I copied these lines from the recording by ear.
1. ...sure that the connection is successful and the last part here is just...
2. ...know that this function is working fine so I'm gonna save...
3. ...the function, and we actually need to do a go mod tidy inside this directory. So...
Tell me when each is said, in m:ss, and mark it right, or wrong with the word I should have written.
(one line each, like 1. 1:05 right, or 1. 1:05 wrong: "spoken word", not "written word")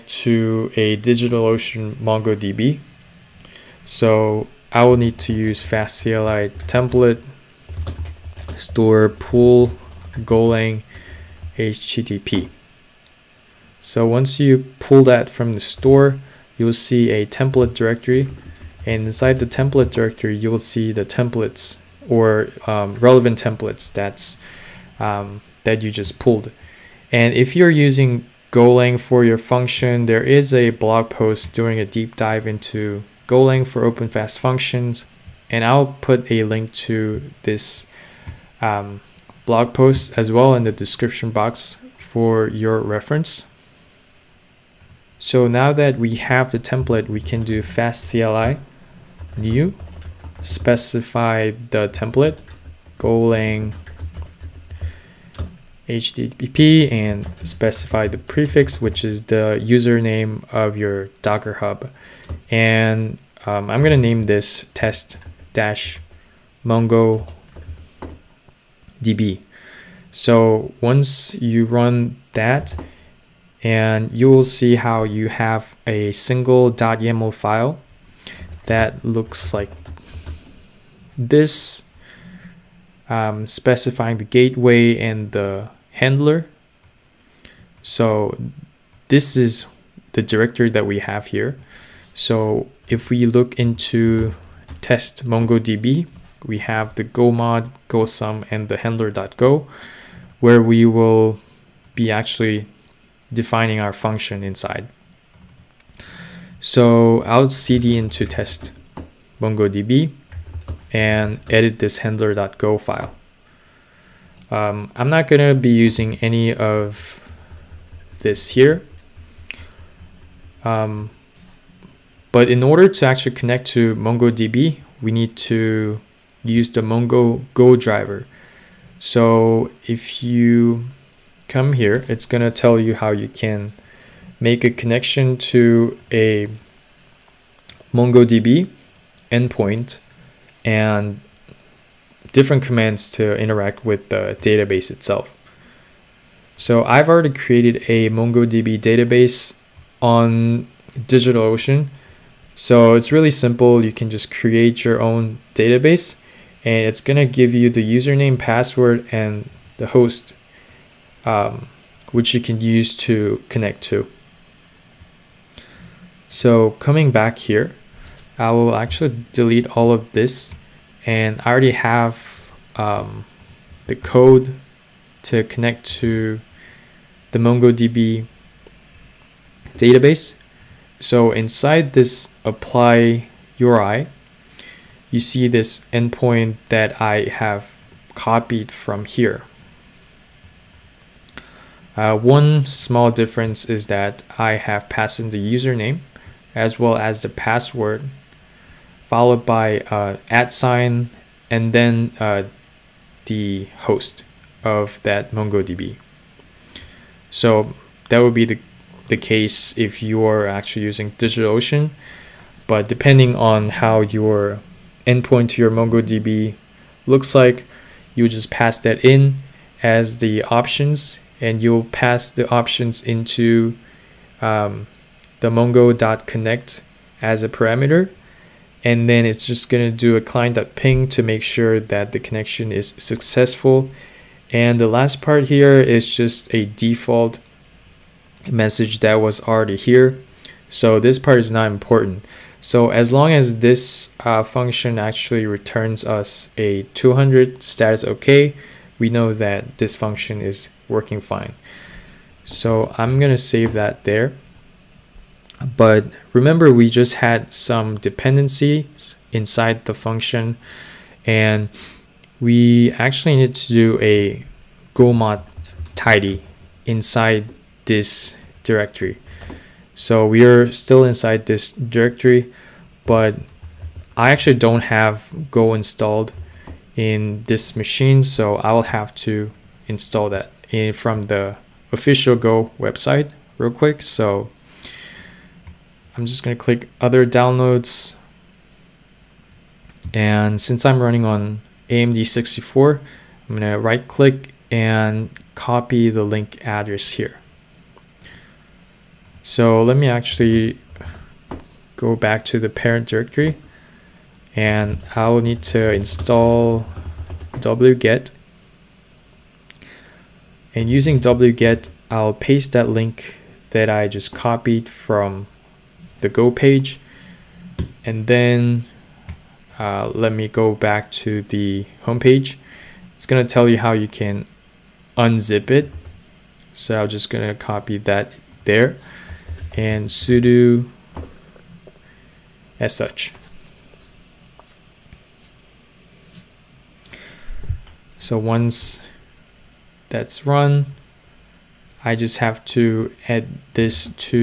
1. 3:51 right
2. 4:09 right
3. 4:19 right.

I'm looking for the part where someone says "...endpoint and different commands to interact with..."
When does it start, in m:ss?
2:19.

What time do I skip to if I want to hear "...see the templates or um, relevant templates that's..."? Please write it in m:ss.
0:20.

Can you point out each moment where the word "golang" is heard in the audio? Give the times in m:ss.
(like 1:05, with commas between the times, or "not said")
0:10, 0:28, 0:33, 0:52.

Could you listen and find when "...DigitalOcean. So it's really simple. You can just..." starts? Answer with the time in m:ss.
2:30.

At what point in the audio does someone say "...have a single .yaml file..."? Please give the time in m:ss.
1:15.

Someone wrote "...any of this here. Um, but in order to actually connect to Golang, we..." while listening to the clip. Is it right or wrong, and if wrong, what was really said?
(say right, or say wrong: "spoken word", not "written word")
wrong: "MongoDB", not "Golang".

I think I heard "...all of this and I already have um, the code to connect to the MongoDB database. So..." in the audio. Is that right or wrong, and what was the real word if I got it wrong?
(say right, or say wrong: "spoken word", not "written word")
right.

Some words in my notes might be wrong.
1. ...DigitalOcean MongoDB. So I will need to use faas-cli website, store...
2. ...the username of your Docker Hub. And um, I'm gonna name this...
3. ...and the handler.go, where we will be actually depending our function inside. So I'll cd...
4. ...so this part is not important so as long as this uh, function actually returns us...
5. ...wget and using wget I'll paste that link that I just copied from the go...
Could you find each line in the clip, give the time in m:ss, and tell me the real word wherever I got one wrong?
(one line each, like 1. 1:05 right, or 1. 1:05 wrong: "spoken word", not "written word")
1. 0:00 wrong: "template", not "website"
2. 0:59 right
3. 1:38 wrong: "defining", not "depending"
4. 4:00 right
5. 5:07 right.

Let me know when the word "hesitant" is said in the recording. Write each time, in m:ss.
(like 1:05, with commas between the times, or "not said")
not said.